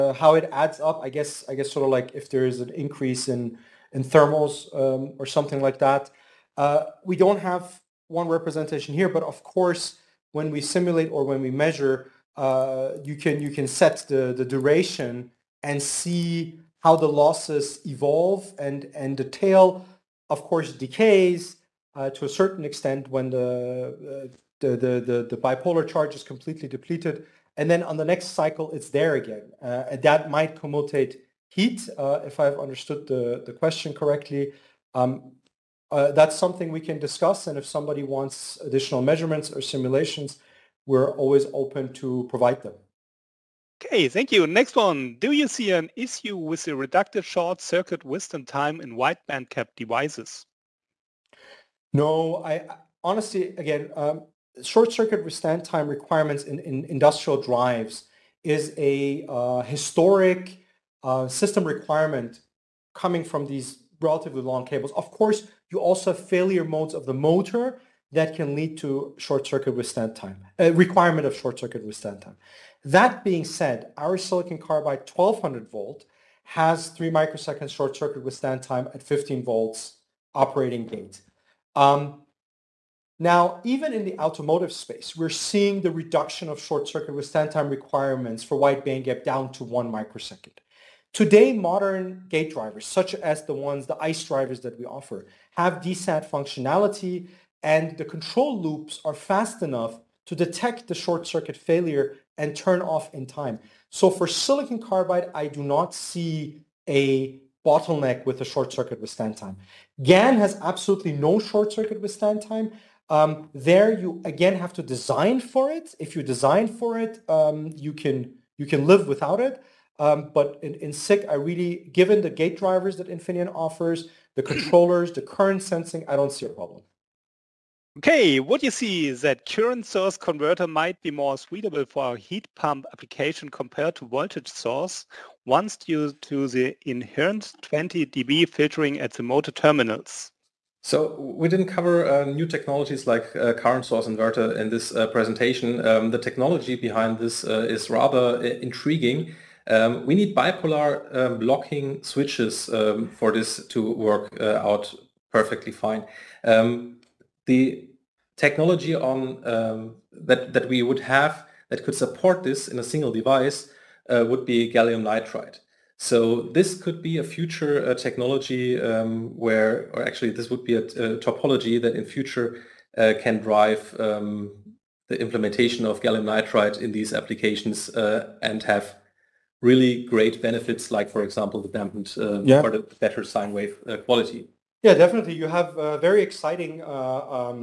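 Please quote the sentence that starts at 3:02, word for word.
or the better sine wave uh, quality.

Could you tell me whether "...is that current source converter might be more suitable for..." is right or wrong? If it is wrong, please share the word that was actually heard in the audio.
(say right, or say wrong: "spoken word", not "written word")
right.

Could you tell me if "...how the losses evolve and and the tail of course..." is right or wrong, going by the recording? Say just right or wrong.
right.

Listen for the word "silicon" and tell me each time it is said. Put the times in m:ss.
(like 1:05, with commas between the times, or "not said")
1:14, 1:44.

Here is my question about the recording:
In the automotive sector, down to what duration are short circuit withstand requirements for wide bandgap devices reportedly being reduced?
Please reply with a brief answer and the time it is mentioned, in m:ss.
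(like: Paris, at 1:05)
1 microsecond, at 1:29.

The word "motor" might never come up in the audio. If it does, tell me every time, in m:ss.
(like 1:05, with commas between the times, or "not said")
1:07, 2:19.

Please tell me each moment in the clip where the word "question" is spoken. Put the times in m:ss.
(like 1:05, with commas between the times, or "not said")
0:33.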